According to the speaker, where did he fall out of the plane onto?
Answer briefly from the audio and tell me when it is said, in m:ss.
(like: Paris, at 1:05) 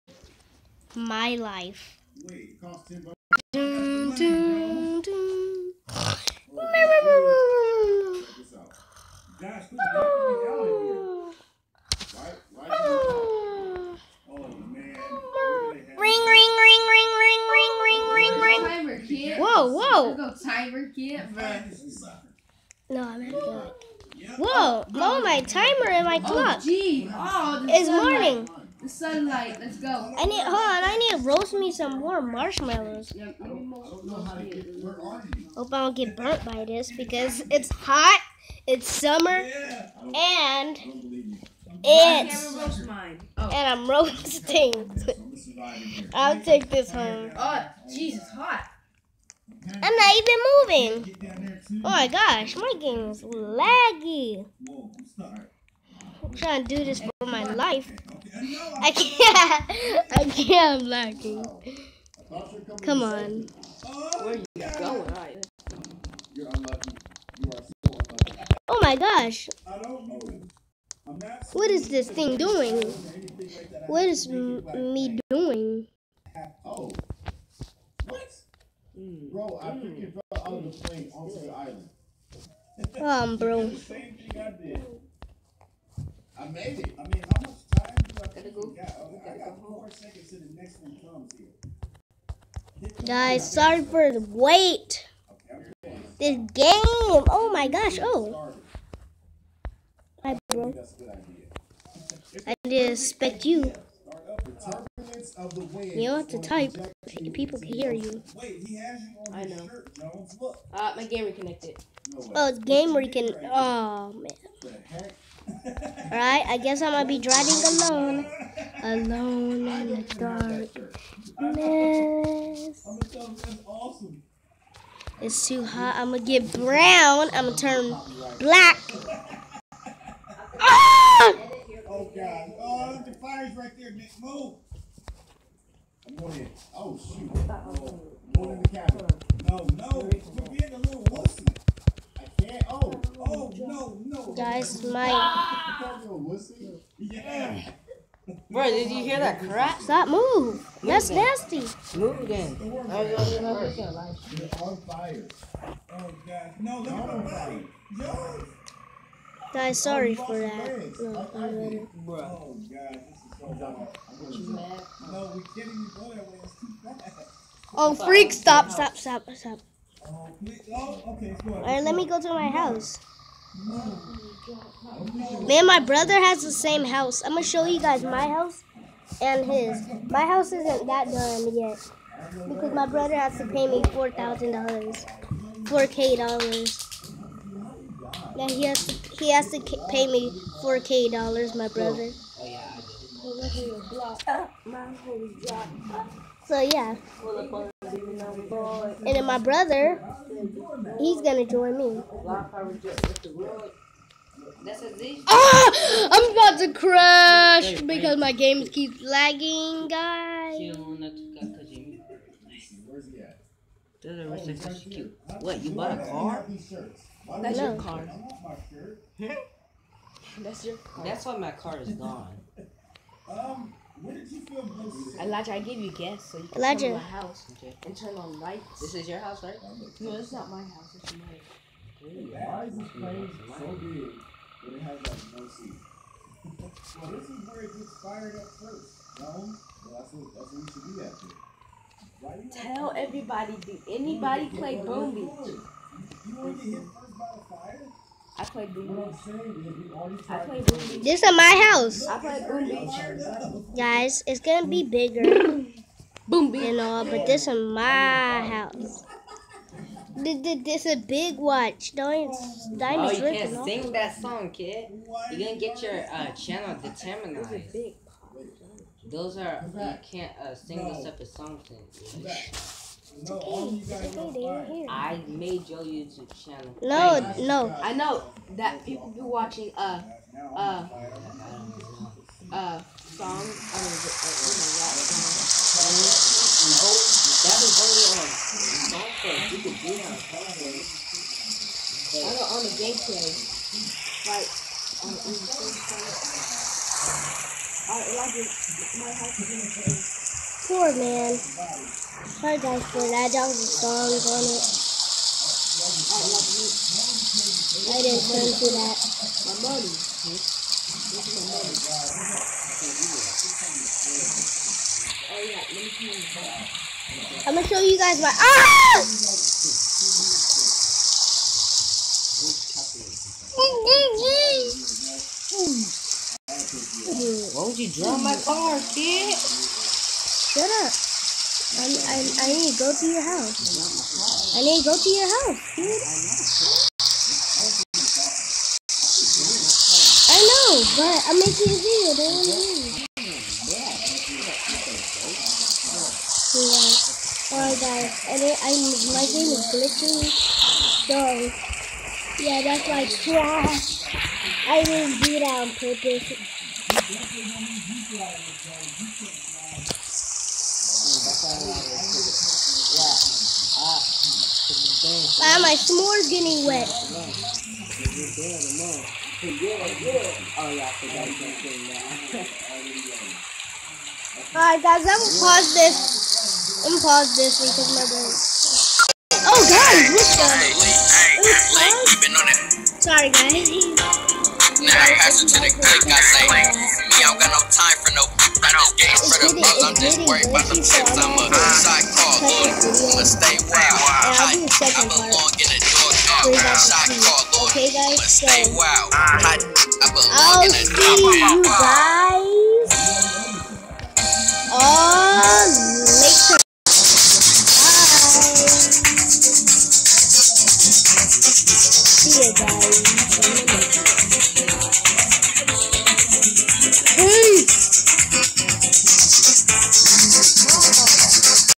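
The island, at 1:21.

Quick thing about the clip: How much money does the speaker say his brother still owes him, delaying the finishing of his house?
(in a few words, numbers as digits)
$4,000.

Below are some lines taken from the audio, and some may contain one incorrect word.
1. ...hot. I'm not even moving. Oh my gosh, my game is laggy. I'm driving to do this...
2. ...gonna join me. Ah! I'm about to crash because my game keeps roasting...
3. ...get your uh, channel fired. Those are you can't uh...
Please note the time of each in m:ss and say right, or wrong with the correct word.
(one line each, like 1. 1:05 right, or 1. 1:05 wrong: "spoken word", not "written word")
1. 0:48 wrong: "trying", not "driving"
2. 3:21 wrong: "lagging", not "roasting"
3. 4:25 wrong: "determinized", not "fired".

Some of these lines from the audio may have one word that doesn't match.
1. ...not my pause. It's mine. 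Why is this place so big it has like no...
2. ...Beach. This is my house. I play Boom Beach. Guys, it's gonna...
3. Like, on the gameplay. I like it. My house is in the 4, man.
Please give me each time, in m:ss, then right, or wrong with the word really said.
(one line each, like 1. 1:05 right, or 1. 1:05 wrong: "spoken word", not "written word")
1. 3:50 wrong: "house", not "pause"
2. 4:08 right
3. 4:54 right.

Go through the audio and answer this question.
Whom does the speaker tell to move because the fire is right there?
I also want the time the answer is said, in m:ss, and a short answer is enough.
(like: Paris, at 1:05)
Nick, at 2:13.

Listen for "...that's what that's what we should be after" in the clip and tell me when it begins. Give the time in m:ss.
3:59.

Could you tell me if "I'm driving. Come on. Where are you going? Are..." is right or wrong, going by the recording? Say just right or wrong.
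wrong.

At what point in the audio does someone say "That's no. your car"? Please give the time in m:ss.
3:37.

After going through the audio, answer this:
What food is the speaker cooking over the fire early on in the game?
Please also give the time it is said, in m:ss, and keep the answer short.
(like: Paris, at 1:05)
Marshmallows, at 0:32.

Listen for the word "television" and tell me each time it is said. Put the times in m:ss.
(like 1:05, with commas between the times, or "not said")
4:50.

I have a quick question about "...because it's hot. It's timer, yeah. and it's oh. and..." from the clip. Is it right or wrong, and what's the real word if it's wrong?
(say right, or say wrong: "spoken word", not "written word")
wrong: "summer", not "timer".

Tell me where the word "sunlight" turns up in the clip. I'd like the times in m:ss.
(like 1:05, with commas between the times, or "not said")
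0:28.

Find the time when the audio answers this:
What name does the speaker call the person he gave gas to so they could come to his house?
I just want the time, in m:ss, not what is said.
3:45.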